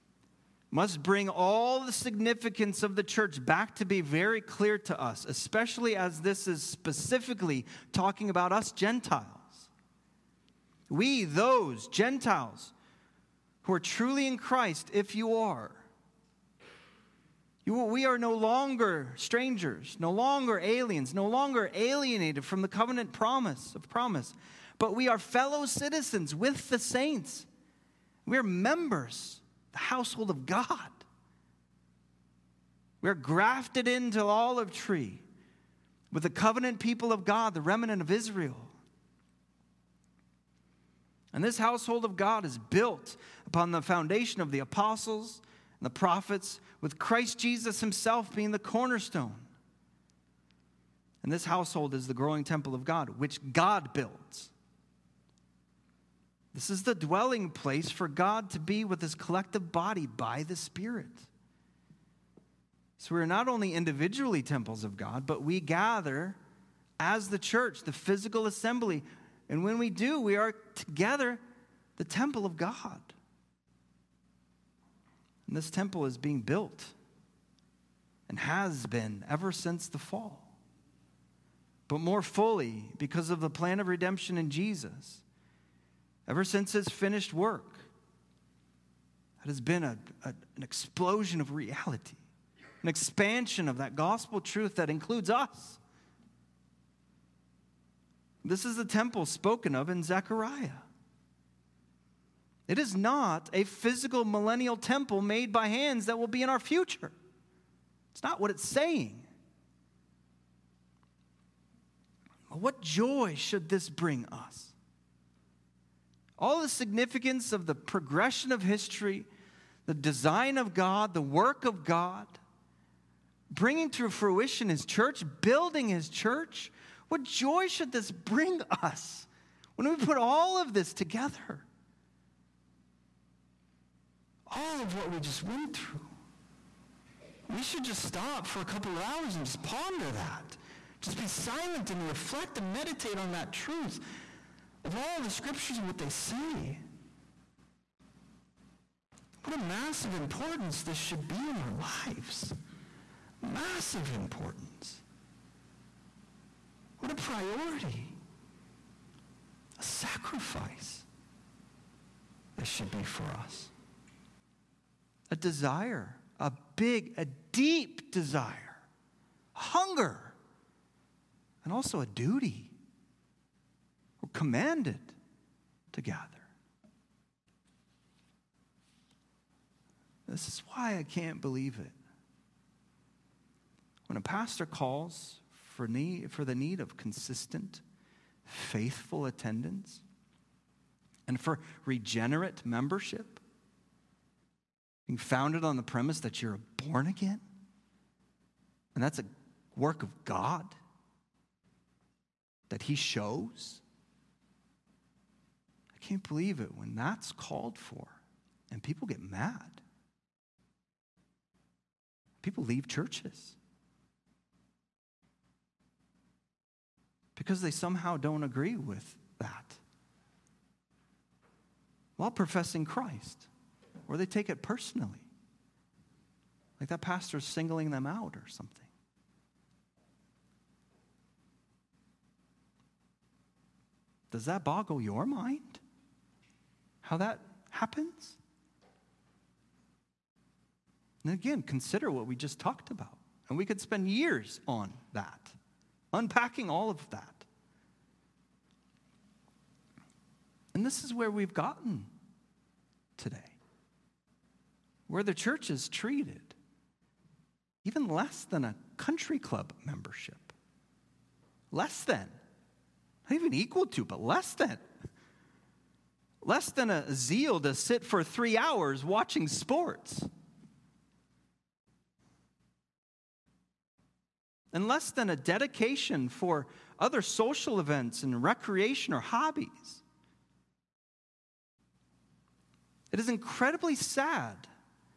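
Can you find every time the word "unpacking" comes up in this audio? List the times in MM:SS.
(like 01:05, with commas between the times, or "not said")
04:06.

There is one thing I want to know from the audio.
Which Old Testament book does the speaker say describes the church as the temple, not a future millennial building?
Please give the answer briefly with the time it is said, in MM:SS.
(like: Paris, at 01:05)
Zechariah, at 01:40.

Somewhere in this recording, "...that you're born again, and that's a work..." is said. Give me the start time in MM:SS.
03:16.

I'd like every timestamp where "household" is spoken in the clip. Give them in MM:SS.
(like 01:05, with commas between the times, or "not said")
00:29, 00:41, 00:51.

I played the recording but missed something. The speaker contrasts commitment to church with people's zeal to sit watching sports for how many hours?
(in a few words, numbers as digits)
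3 hours.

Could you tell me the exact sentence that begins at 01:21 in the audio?
But more fully, because of the plan of redemption in Jesus, ever since his finished work.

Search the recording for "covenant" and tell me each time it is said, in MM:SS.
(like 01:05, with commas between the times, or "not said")
00:22, 00:36.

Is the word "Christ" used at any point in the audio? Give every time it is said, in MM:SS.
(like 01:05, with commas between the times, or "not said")
00:14, 00:46, 03:42.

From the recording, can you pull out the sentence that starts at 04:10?
And this is where we've gotten today, where the church is treated even less than a country club membership.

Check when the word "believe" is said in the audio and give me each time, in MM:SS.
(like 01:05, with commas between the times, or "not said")
03:01, 03:26.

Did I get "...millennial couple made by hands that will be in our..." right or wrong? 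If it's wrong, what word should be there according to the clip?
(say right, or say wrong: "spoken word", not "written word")
wrong: "temple", not "couple".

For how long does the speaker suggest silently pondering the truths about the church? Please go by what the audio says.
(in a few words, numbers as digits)
A couple of hours.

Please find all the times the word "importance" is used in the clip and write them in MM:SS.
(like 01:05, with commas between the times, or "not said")
02:30, 02:34.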